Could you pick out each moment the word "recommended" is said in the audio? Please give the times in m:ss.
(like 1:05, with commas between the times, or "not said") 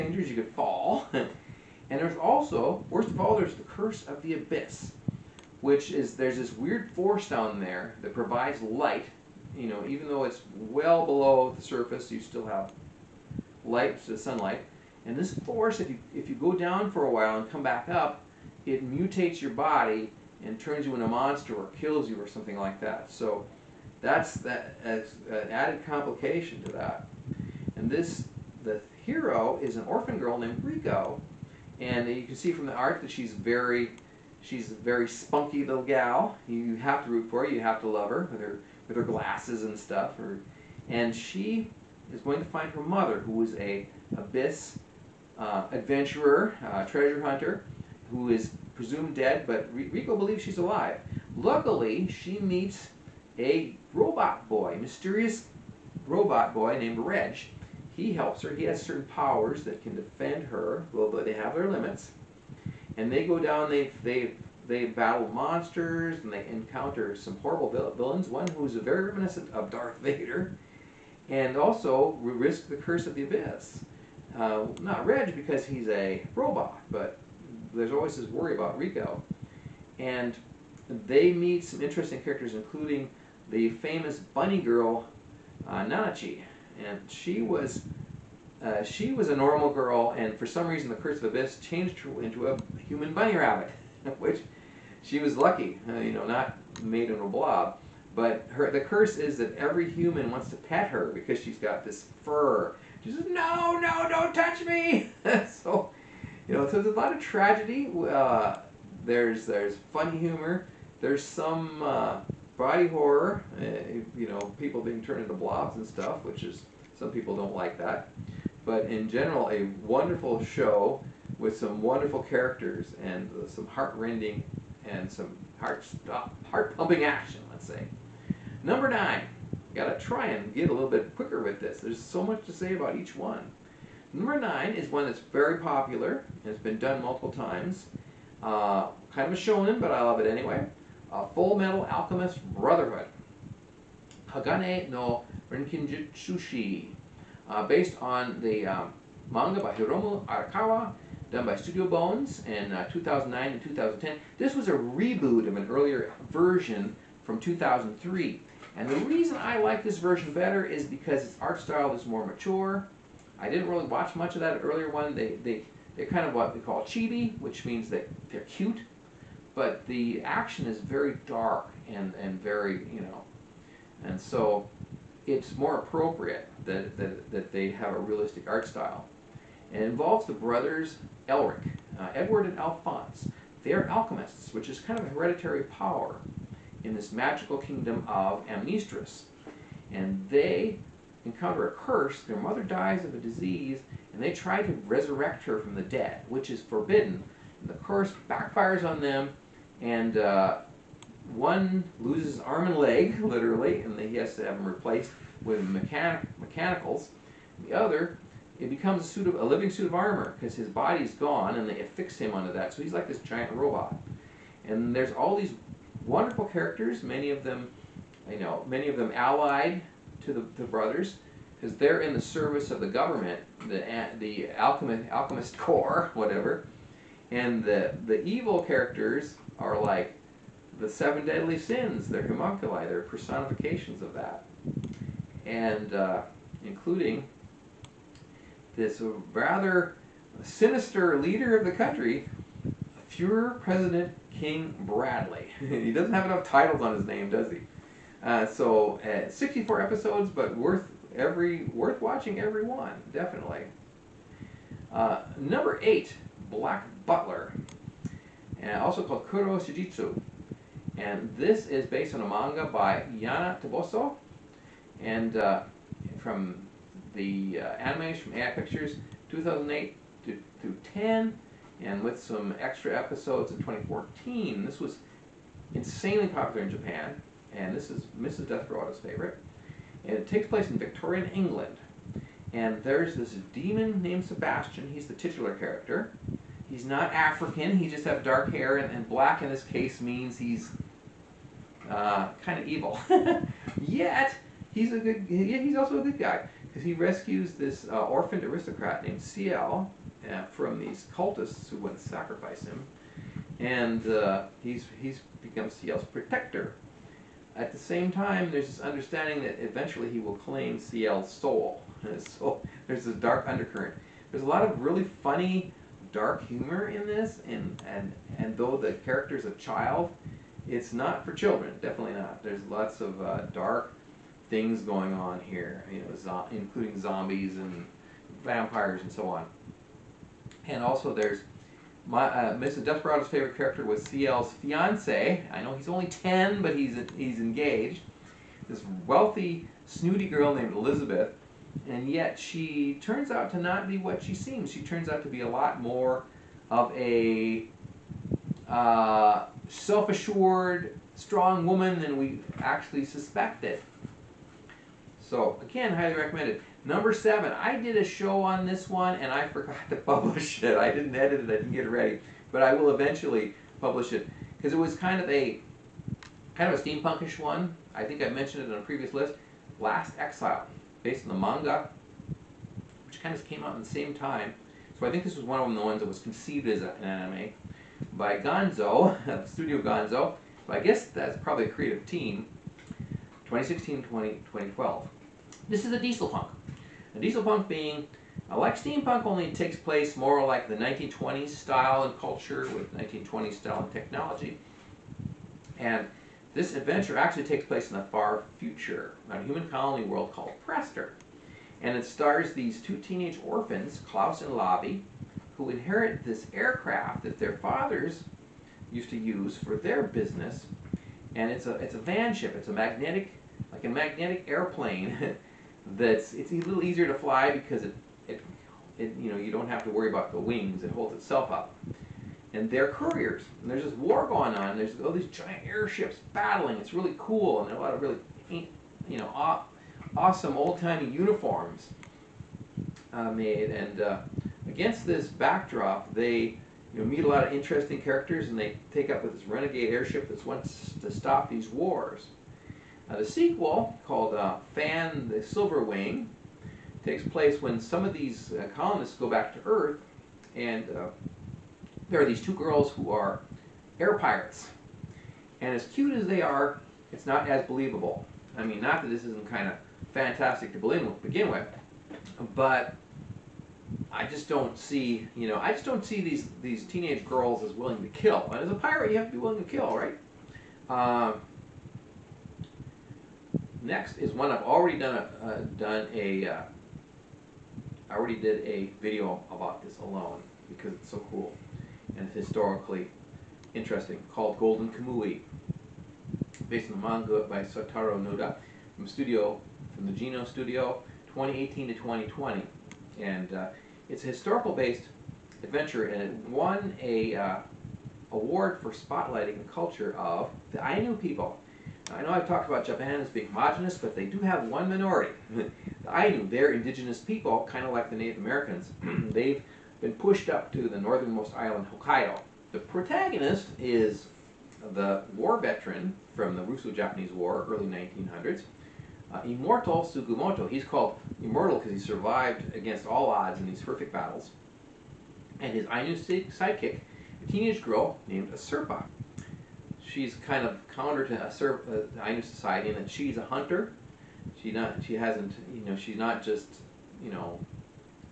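5:56.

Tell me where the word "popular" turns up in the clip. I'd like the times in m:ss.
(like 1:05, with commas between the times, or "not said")
2:15, 4:36.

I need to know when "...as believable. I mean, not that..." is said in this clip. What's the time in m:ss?
7:37.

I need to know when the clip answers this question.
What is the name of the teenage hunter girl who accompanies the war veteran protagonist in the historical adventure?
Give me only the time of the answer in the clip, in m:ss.
8:48.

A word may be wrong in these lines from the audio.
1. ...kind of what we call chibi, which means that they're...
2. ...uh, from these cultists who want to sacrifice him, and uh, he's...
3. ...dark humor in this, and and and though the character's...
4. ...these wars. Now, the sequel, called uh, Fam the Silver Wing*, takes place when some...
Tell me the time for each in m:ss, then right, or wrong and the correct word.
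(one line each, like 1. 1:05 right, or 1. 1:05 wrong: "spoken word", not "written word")
1. 2:46 right
2. 5:00 right
3. 5:16 right
4. 7:21 right.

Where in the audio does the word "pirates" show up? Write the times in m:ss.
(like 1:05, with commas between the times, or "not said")
7:34, 7:48.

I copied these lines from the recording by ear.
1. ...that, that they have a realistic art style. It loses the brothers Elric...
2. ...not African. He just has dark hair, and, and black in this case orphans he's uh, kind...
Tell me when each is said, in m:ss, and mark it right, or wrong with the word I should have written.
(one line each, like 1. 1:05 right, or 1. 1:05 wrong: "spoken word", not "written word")
1. 2:56 wrong: "involves", not "loses"
2. 4:46 wrong: "means", not "orphans".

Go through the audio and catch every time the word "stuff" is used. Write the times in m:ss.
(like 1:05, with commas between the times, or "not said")
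0:39, 1:55.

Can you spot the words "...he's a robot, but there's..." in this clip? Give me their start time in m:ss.
1:15.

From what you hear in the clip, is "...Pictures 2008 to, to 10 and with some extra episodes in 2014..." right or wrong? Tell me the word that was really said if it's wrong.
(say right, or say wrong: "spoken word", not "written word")
right.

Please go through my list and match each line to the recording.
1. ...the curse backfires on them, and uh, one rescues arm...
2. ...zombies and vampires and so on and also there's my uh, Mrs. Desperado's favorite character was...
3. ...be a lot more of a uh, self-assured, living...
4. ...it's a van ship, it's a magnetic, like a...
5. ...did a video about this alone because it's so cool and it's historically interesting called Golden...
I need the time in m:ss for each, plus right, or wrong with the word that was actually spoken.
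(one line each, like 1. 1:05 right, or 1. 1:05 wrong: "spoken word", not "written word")
1. 3:17 wrong: "loses", not "rescues"
2. 5:27 right
3. 5:45 wrong: "strong", not "living"
4. 6:51 right
5. 7:58 right.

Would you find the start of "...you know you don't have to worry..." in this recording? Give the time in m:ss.
6:59.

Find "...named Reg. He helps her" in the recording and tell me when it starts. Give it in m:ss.
0:56.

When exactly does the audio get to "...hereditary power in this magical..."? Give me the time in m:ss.
3:05.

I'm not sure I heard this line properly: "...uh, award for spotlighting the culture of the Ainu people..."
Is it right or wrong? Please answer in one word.
right.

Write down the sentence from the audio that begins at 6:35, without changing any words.
And this adventure actually takes place in the far future, on a human colony world called Prester.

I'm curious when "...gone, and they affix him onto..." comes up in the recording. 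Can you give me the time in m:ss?
3:31.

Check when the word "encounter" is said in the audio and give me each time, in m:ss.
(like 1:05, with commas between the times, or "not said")
1:06, 3:11.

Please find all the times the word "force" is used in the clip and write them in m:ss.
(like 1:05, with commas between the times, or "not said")
0:06, 0:15.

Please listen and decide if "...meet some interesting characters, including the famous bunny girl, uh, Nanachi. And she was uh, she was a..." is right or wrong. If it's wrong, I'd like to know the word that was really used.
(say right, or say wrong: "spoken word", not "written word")
right.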